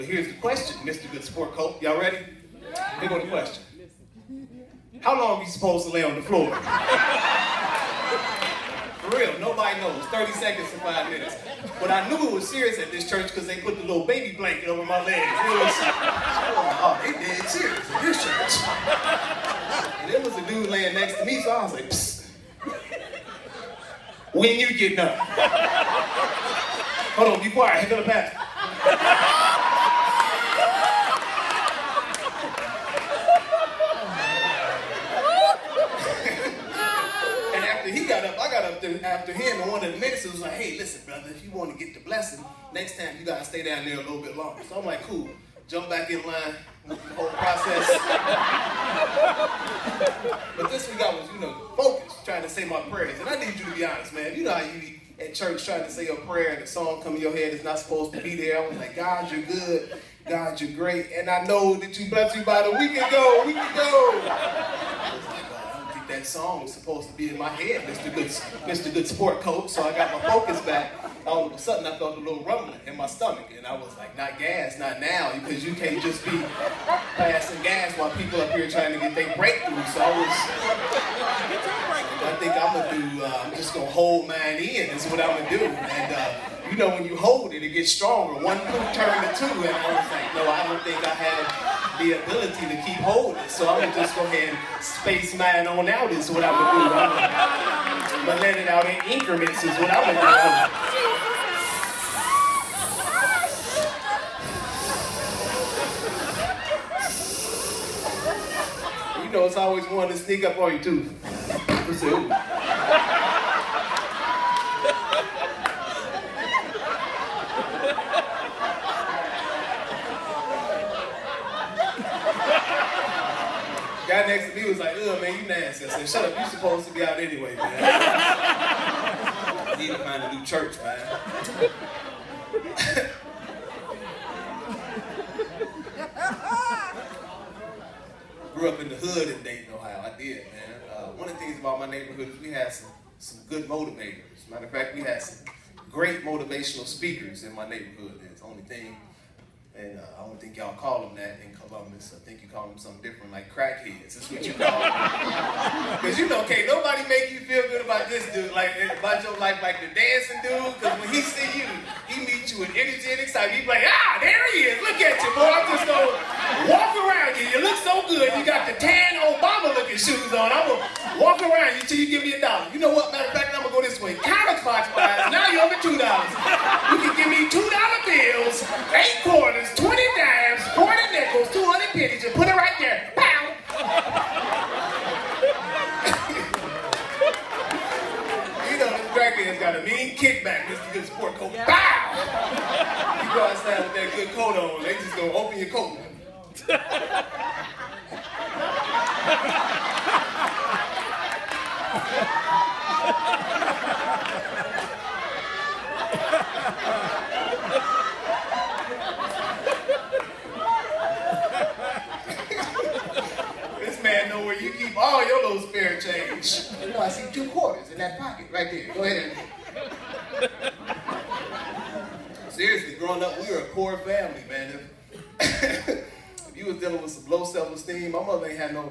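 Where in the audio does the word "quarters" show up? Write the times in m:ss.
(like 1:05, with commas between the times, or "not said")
2:59, 3:37.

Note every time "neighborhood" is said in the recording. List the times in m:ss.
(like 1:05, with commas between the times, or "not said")
2:21, 2:27.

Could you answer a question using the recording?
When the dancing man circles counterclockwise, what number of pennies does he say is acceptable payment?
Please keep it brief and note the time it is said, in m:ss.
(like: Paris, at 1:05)
200, at 3:01.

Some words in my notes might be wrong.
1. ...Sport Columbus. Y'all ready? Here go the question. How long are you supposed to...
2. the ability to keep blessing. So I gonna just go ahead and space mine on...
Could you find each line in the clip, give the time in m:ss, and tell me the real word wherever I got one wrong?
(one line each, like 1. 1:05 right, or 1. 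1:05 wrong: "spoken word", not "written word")
1. 0:01 wrong: "Coat", not "Columbus"
2. 1:32 wrong: "holding", not "blessing".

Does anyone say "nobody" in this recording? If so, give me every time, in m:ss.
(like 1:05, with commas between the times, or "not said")
0:09, 2:36.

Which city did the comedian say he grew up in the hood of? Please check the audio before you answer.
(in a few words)
Dayton, Ohio.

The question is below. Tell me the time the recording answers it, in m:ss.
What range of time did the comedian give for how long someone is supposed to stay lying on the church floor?
0:10.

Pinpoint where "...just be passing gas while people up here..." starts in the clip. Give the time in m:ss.
1:16.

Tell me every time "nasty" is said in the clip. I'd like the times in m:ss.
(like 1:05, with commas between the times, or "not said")
2:05.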